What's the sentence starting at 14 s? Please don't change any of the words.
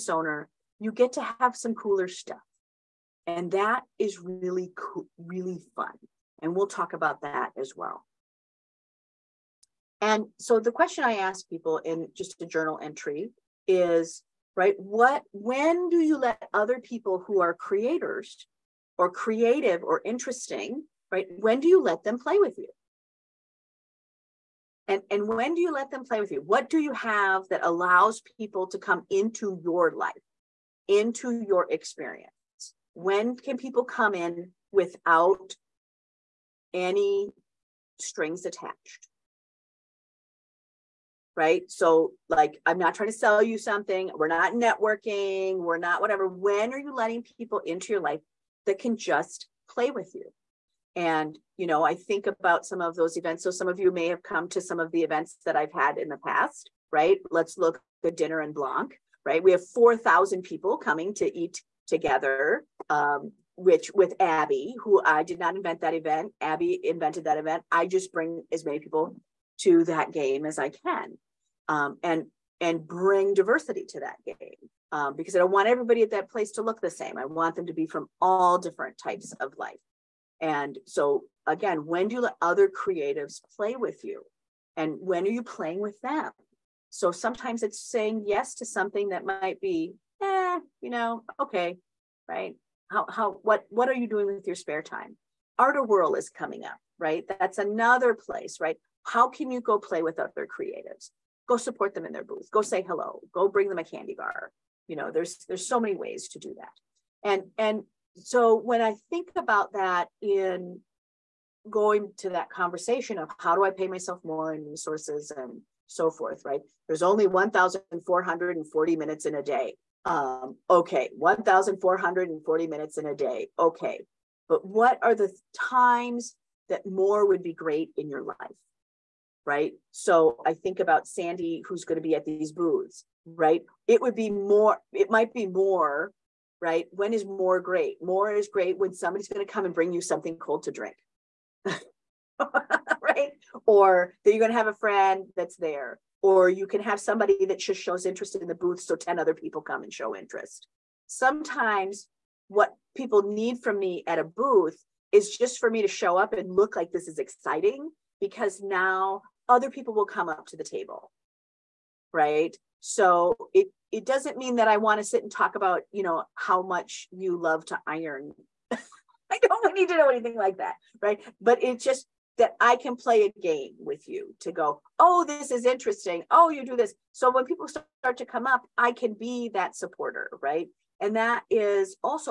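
What, when do you let other people who are creators or creative or interesting, right?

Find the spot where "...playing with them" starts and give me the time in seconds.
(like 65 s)
85 s.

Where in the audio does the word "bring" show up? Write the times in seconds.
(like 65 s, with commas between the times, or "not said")
68 s, 72 s, 103 s, 139 s.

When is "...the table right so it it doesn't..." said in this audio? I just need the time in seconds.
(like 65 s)
160 s.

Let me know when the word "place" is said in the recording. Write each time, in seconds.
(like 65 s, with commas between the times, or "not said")
76 s, 98 s.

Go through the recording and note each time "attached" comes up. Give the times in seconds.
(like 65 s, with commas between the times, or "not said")
38 s.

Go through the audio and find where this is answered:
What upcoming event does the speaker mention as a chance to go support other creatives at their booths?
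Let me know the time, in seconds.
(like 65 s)
95 s.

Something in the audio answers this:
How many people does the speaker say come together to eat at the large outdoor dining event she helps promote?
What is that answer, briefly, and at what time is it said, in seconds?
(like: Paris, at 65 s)
4,000, at 59 s.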